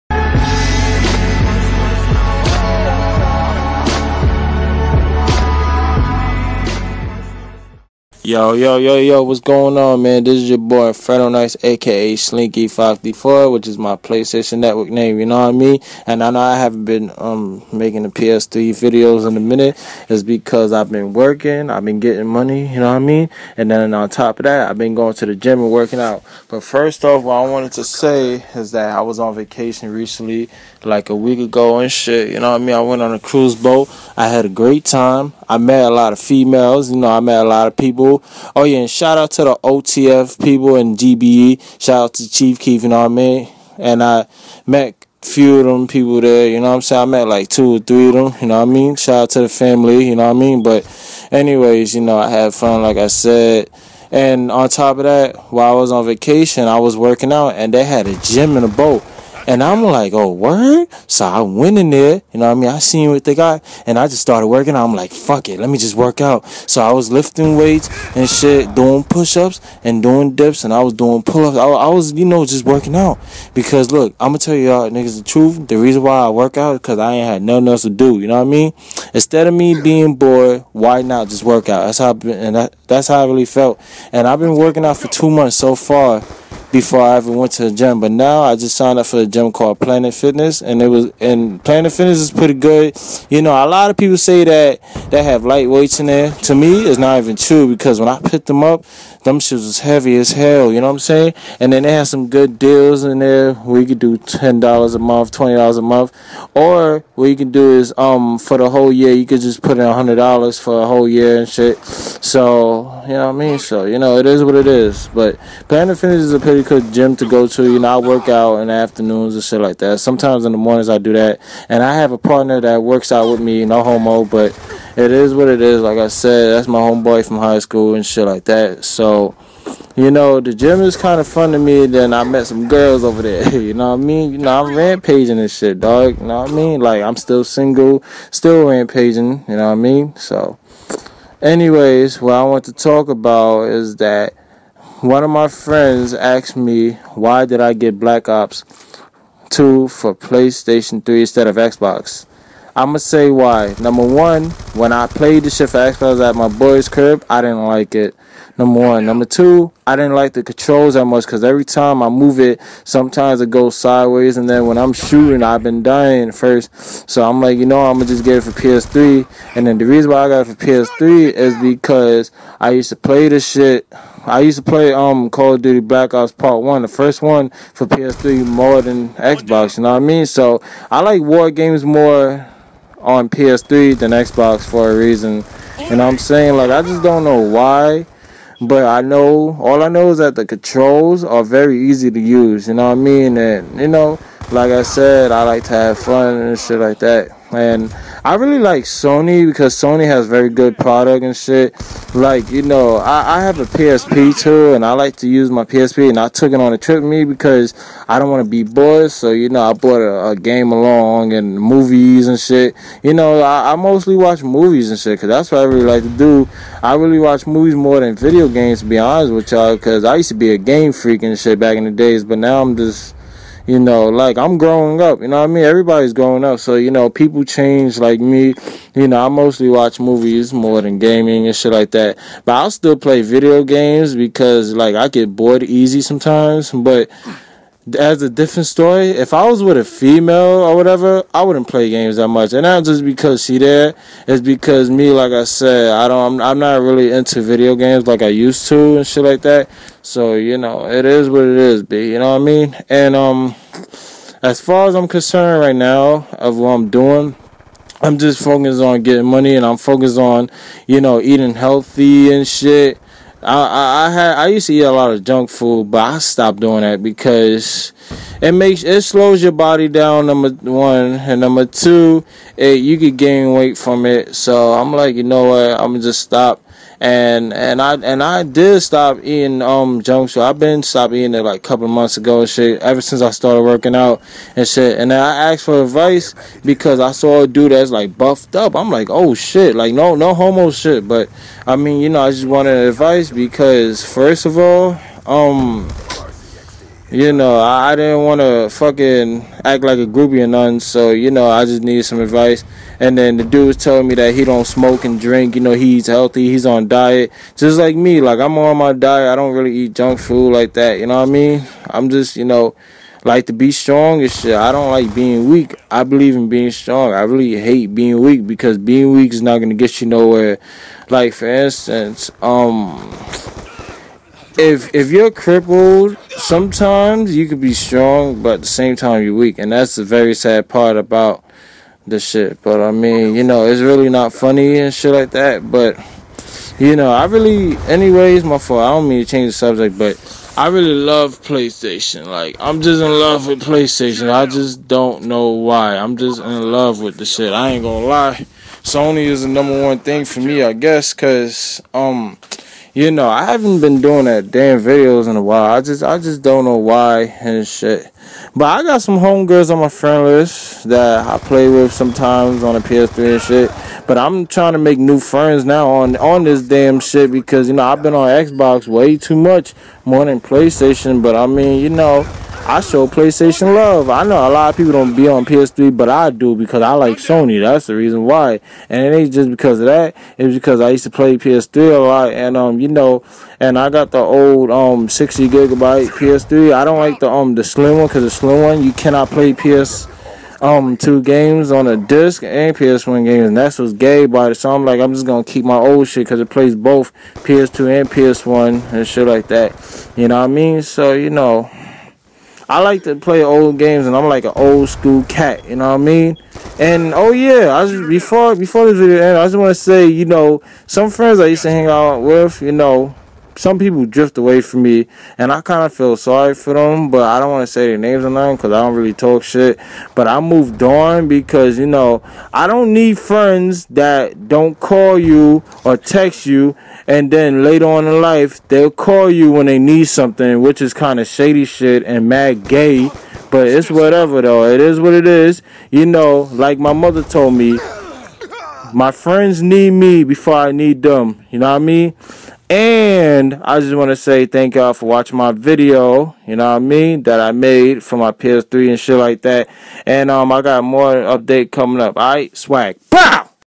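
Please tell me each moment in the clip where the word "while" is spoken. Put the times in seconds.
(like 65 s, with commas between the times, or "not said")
55 s, 355 s.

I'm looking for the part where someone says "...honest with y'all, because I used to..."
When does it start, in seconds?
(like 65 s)
218 s.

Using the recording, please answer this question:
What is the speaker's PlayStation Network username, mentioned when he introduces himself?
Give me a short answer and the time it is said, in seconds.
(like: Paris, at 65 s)
Slinky554, at 12 s.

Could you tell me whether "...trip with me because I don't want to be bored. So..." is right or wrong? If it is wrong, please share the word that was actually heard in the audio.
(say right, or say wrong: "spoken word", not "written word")
right.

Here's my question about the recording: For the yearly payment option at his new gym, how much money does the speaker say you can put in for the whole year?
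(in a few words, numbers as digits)
$100.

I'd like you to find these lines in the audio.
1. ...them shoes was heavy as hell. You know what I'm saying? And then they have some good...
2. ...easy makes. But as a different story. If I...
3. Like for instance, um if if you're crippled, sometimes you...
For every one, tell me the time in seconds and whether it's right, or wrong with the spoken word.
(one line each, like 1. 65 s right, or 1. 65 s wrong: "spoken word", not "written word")
1. 99 s right
2. 235 s wrong: "sometimes", not "makes"
3. 321 s right.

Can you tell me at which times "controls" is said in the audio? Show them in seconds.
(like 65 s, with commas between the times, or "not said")
160 s, 190 s.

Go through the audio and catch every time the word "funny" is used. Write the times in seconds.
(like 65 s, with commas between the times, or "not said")
334 s.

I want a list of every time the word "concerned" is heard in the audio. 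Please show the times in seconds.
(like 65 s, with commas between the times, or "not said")
255 s.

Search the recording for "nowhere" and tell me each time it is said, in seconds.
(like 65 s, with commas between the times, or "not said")
320 s.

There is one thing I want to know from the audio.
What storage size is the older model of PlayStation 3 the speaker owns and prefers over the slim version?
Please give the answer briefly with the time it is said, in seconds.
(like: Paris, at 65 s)
60 gigabytes, at 385 s.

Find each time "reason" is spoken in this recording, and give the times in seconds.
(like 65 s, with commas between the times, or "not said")
75 s, 169 s, 184 s, 377 s.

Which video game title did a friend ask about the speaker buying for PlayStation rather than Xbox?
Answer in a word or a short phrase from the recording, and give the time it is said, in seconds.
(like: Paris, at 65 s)
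Black Ops 2, at 147 s.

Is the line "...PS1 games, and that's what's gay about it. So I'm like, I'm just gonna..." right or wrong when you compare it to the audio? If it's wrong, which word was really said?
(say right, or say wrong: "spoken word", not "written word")
right.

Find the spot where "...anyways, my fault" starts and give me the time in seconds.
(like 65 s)
337 s.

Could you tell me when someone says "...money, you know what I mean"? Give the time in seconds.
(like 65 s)
22 s.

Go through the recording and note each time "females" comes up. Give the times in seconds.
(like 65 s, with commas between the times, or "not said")
36 s, 239 s.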